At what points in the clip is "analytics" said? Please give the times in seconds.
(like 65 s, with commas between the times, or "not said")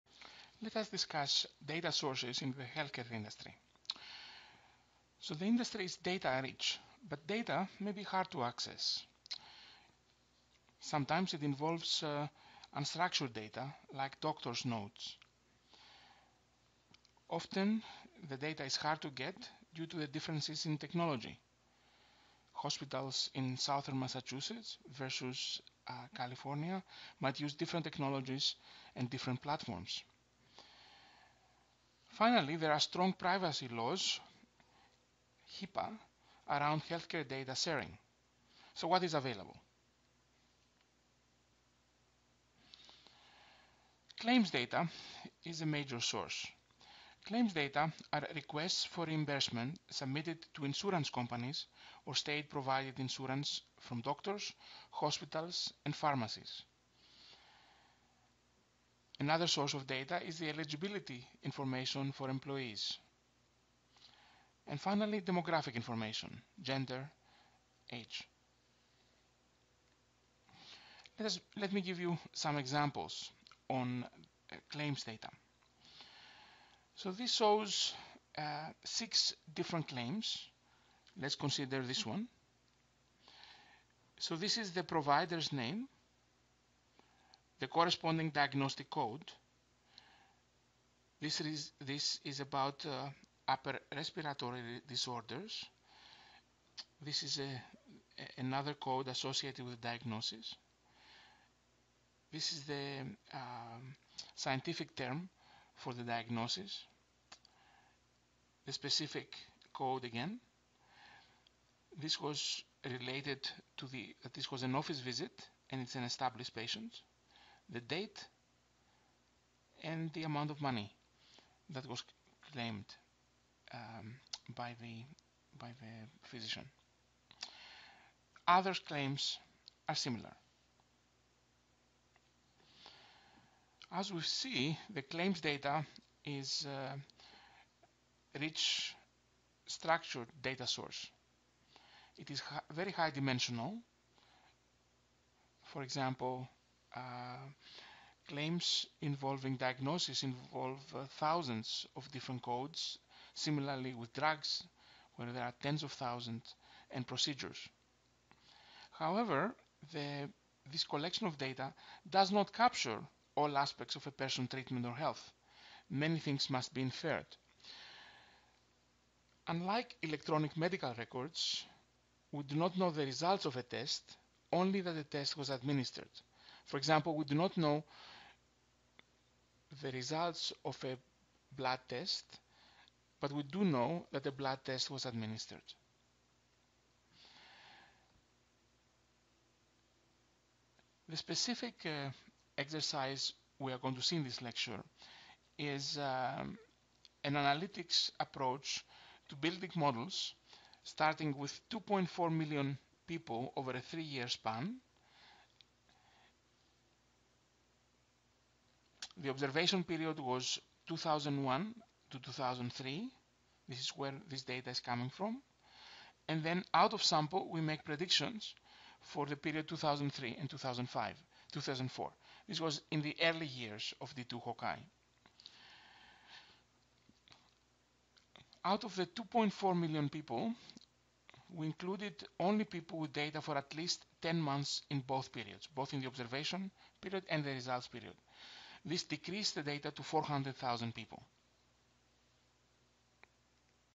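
197 s.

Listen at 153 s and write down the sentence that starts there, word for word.
Similarly with drugs, where there are tens of thousands and procedures.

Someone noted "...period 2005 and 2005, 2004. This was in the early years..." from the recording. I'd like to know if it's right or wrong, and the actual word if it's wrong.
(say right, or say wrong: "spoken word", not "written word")
wrong: "2003", not "2005".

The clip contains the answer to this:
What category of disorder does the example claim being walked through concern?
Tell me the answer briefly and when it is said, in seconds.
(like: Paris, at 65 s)
upper respiratory disorders, at 93 s.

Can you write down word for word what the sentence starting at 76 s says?
So this shows uh, six different claims.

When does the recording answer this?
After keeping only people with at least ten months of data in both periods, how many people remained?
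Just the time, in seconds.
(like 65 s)
240 s.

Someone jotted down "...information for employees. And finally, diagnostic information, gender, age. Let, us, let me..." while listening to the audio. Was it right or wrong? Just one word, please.
wrong.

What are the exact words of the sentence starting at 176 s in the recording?
For example, we do not know the results of a blood test, but we do know that the blood test was administered.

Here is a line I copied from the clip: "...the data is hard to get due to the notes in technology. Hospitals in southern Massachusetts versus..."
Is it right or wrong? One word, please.
wrong.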